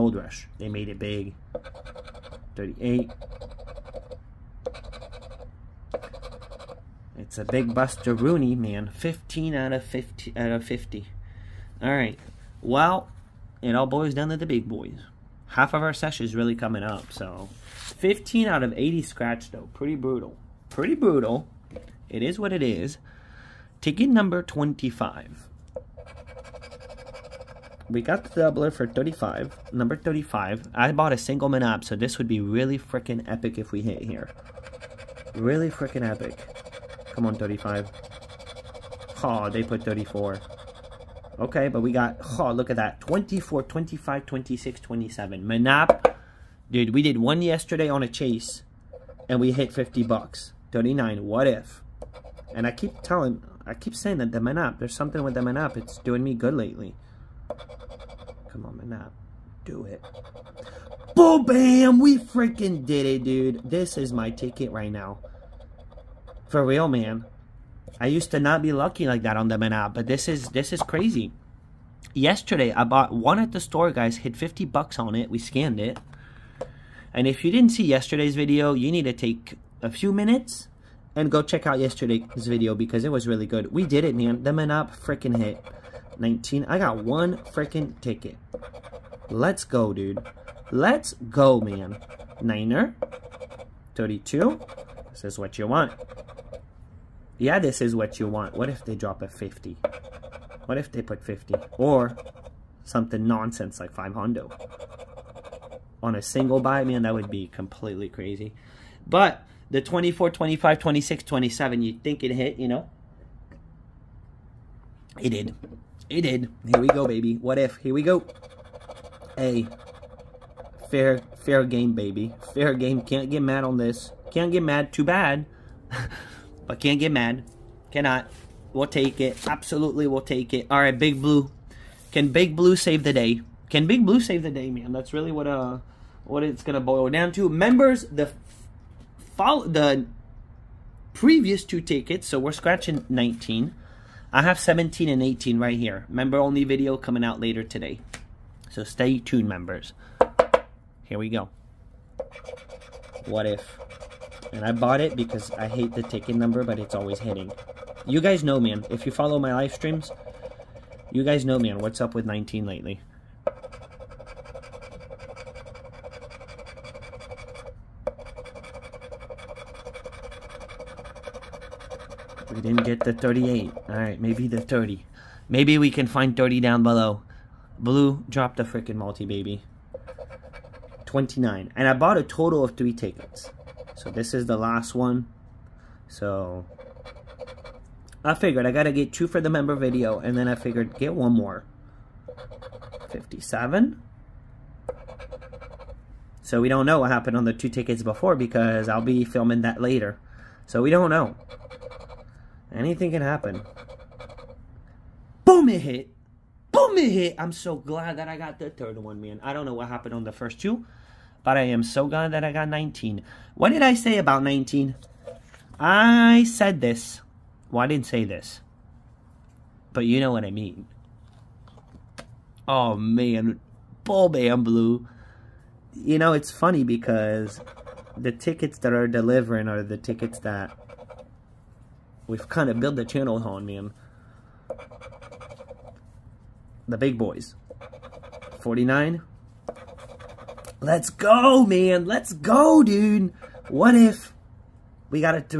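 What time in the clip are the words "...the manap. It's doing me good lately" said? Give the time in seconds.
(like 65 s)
55 s.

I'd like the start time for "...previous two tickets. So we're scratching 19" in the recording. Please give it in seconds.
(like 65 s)
141 s.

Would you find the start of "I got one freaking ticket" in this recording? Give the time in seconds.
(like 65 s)
86 s.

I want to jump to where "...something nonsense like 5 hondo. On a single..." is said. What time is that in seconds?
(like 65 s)
102 s.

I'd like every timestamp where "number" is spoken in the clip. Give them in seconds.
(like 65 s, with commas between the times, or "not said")
24 s, 29 s, 156 s.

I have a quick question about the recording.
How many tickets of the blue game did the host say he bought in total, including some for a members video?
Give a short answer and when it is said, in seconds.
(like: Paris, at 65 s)
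3, at 182 s.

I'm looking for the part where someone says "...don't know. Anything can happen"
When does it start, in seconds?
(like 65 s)
200 s.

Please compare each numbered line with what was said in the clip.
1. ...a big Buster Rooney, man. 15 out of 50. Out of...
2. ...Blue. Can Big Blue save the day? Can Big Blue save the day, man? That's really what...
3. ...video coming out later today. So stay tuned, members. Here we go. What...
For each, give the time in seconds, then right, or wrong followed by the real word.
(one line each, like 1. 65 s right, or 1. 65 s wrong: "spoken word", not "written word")
1. 7 s right
2. 131 s right
3. 146 s right.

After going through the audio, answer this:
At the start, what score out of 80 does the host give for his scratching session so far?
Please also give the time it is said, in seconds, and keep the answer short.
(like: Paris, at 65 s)
15, at 17 s.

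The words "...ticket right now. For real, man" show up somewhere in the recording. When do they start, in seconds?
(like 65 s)
64 s.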